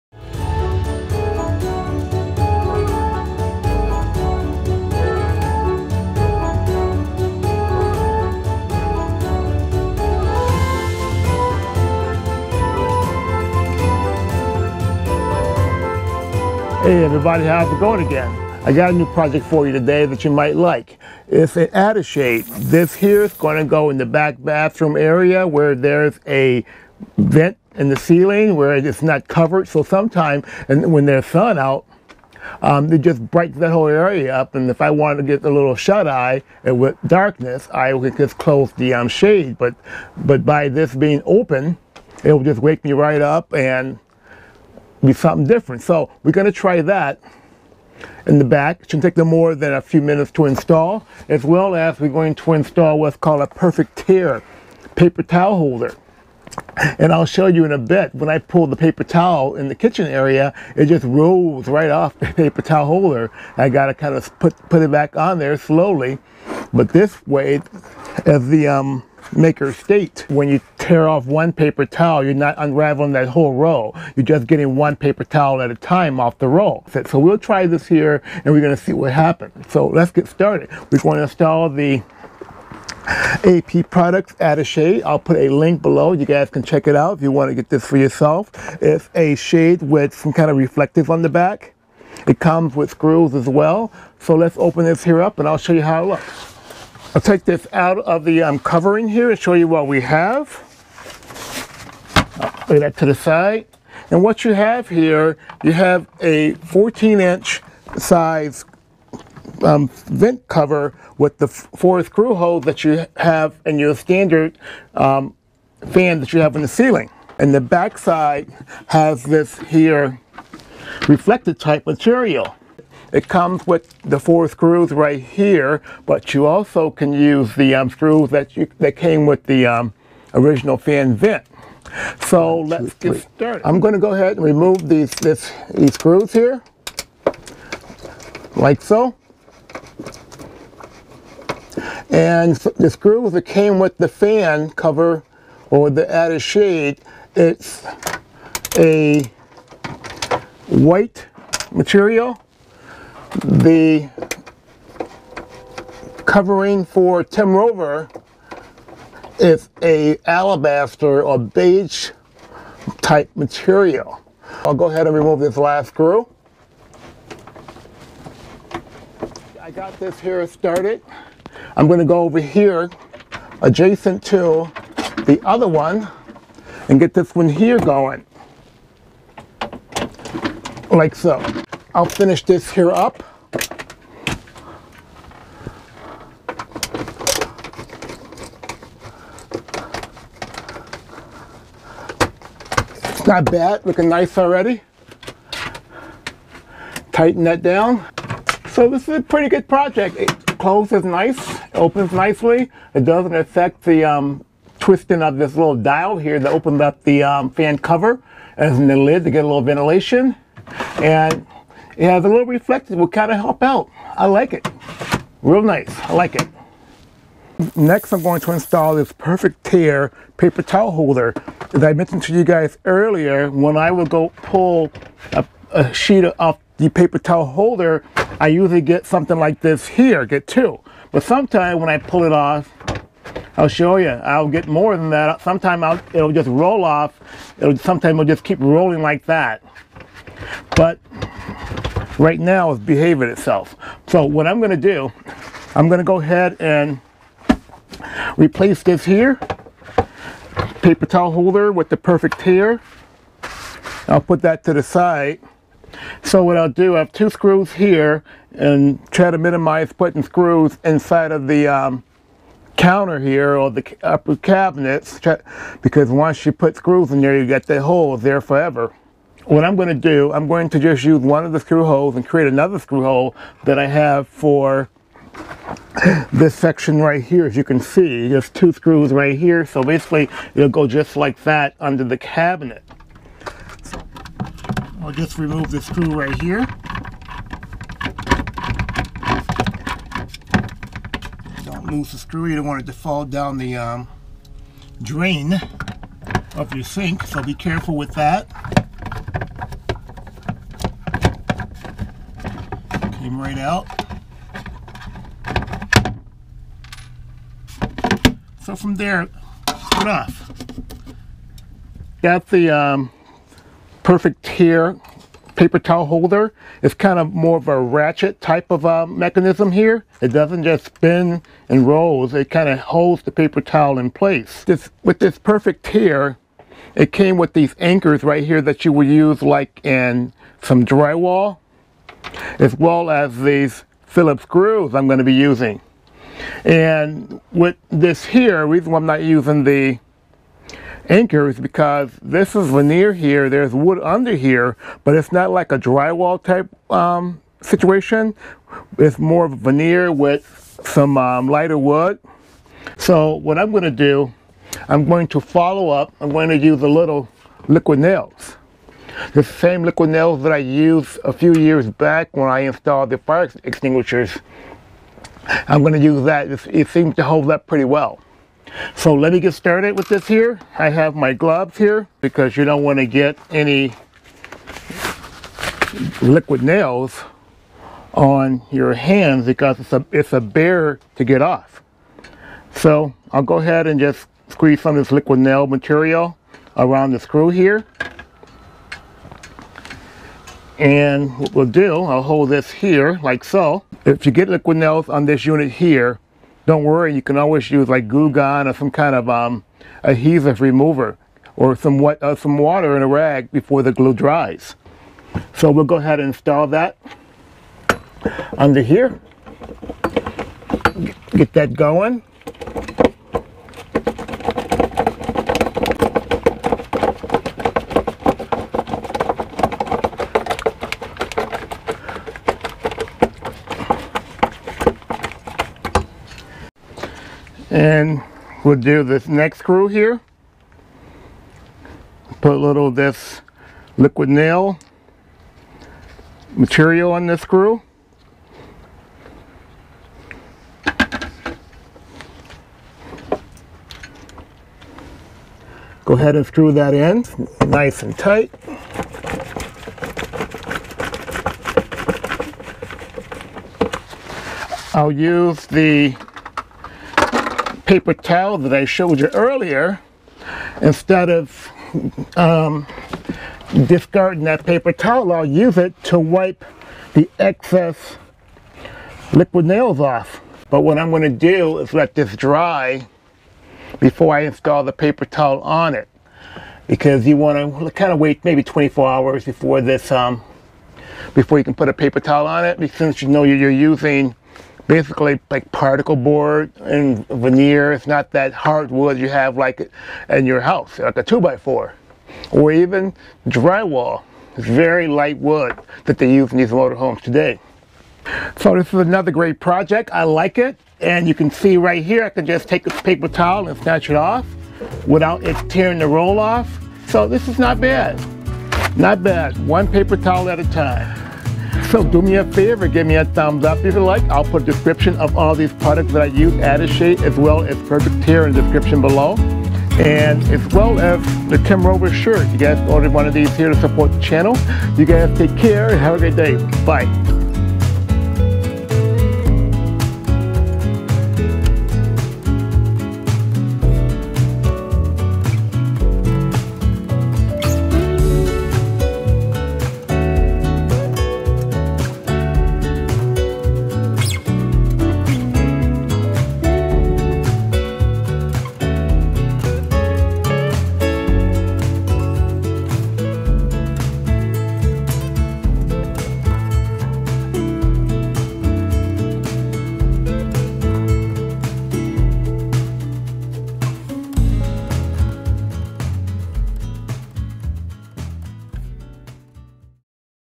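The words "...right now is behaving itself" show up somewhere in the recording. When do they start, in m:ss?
4:02.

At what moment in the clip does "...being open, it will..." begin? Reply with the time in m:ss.
0:40.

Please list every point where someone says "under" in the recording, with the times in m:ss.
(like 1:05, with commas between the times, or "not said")
4:41, 5:44, 6:48.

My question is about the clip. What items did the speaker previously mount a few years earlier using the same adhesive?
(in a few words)
Fire extinguishers.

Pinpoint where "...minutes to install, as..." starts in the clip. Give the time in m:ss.
0:50.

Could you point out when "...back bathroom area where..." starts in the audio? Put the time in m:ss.
0:24.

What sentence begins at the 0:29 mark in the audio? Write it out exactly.
So sometime, and when there's sun out, um, it just brightens that whole area up.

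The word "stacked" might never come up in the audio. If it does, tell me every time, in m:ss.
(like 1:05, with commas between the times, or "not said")
not said.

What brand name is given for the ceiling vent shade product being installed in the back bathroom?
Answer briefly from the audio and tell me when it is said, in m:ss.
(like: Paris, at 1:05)
AP Products, at 1:23.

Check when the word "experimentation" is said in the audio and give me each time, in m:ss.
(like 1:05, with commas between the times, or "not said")
not said.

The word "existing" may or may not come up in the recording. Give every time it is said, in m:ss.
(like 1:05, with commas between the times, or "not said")
not said.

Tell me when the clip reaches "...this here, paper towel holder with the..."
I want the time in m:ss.
4:08.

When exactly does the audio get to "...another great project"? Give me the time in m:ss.
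8:18.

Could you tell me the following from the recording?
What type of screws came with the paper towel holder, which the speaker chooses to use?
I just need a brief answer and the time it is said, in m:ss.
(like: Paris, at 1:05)
Phillips, at 5:34.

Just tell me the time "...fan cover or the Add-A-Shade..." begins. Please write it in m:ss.
2:24.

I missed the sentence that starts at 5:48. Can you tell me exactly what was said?
It's more of veneer with some um, lighter wood.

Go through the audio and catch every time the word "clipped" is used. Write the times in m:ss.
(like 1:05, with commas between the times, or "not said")
not said.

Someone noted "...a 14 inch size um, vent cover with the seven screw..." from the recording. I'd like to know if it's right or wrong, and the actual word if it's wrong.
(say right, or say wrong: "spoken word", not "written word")
wrong: "four", not "seven".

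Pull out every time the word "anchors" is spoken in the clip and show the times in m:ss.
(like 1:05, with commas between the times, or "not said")
5:27, 5:41.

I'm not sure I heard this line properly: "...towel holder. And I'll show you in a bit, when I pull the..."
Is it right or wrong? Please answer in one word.
right.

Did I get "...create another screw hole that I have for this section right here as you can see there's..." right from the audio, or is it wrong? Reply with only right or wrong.
right.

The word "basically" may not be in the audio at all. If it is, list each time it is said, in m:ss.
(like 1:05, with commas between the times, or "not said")
4:39, 8:04.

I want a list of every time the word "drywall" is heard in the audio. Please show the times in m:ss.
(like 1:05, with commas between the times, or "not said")
5:30, 5:45, 8:13.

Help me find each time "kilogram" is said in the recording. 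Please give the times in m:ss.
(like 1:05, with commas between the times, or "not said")
not said.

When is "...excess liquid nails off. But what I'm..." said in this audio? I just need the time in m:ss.
7:47.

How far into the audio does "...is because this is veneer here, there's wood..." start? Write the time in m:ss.
5:41.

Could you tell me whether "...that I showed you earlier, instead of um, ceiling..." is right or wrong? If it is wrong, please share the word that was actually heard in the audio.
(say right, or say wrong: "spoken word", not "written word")
wrong: "discarding", not "ceiling".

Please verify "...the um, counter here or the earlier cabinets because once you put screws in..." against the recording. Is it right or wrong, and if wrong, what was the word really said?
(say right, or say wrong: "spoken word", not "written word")
wrong: "upper", not "earlier".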